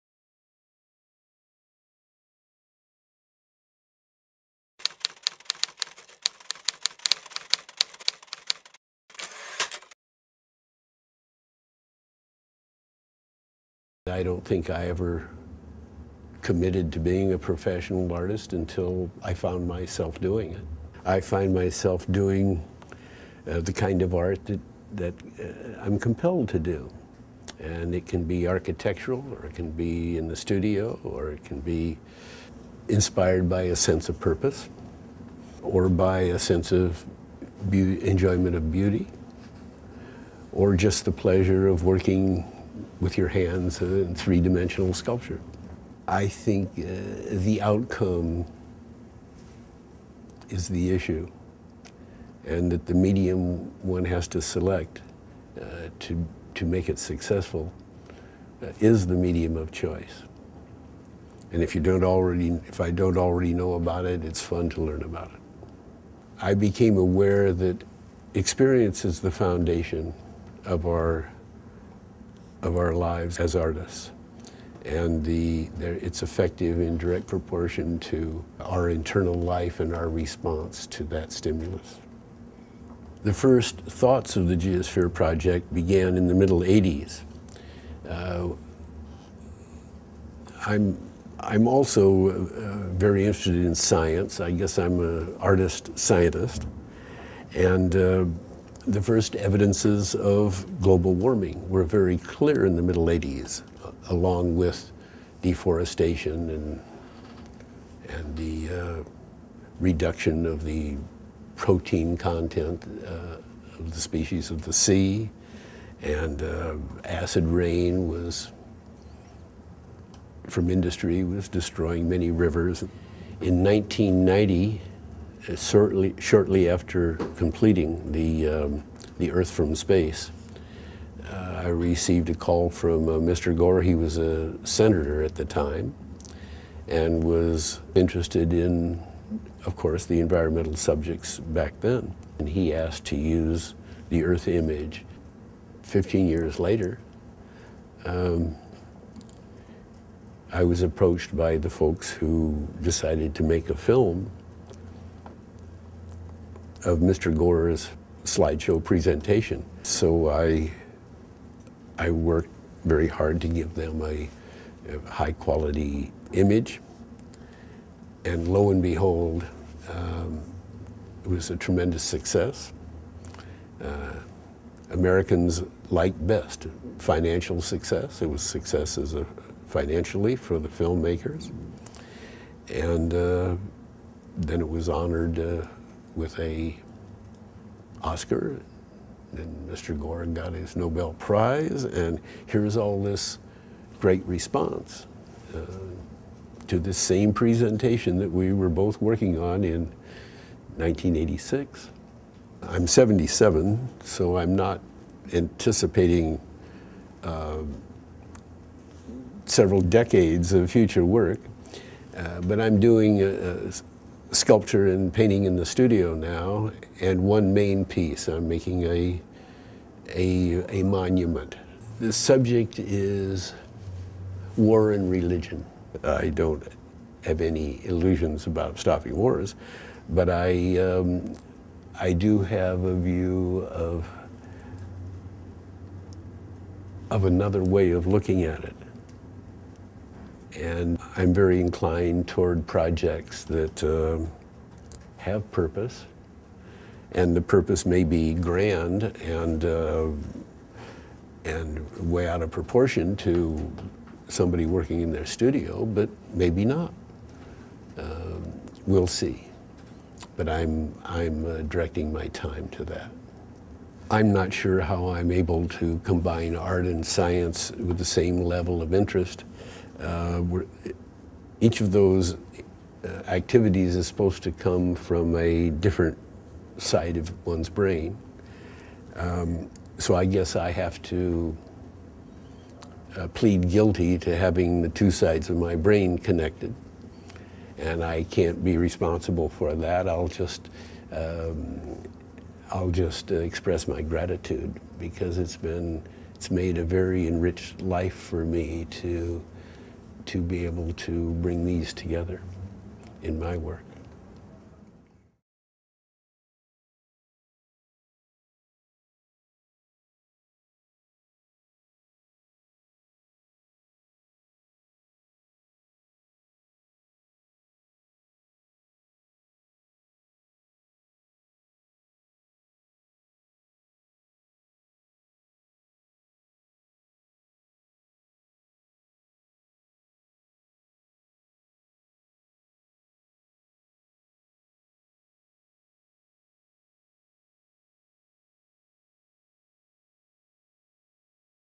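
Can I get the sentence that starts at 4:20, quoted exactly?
But I'm I'm uh, directing my time to that.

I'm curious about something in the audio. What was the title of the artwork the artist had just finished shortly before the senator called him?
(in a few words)
Earth from Space.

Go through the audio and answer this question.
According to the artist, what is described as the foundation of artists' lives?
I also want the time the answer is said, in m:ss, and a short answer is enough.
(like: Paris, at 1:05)
Experience, at 1:08.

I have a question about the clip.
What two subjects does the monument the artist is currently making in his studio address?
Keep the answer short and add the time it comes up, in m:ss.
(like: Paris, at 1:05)
War and religion, at 3:44.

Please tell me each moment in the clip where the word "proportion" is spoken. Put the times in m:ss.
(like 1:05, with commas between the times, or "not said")
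1:17, 4:12.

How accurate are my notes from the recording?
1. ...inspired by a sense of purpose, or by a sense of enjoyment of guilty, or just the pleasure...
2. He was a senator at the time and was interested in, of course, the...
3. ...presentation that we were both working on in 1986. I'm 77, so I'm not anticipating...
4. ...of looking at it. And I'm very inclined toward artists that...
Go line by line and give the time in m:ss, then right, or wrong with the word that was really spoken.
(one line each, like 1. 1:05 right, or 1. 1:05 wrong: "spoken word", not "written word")
1. 0:32 wrong: "beauty", not "guilty"
2. 2:13 right
3. 3:17 right
4. 3:57 wrong: "projects", not "artists".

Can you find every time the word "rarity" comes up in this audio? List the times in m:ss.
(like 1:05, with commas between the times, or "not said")
not said.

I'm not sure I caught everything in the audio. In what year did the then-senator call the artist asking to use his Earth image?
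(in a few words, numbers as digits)
1990.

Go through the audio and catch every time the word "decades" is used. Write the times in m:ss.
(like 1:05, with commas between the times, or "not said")
3:29.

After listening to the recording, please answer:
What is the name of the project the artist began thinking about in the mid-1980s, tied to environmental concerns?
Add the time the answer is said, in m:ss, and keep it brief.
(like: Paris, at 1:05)
Geosphere Project, at 1:24.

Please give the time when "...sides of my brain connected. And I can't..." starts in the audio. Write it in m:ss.
4:45.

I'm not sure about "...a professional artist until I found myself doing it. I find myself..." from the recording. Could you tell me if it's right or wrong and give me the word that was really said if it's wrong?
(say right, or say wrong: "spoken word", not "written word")
right.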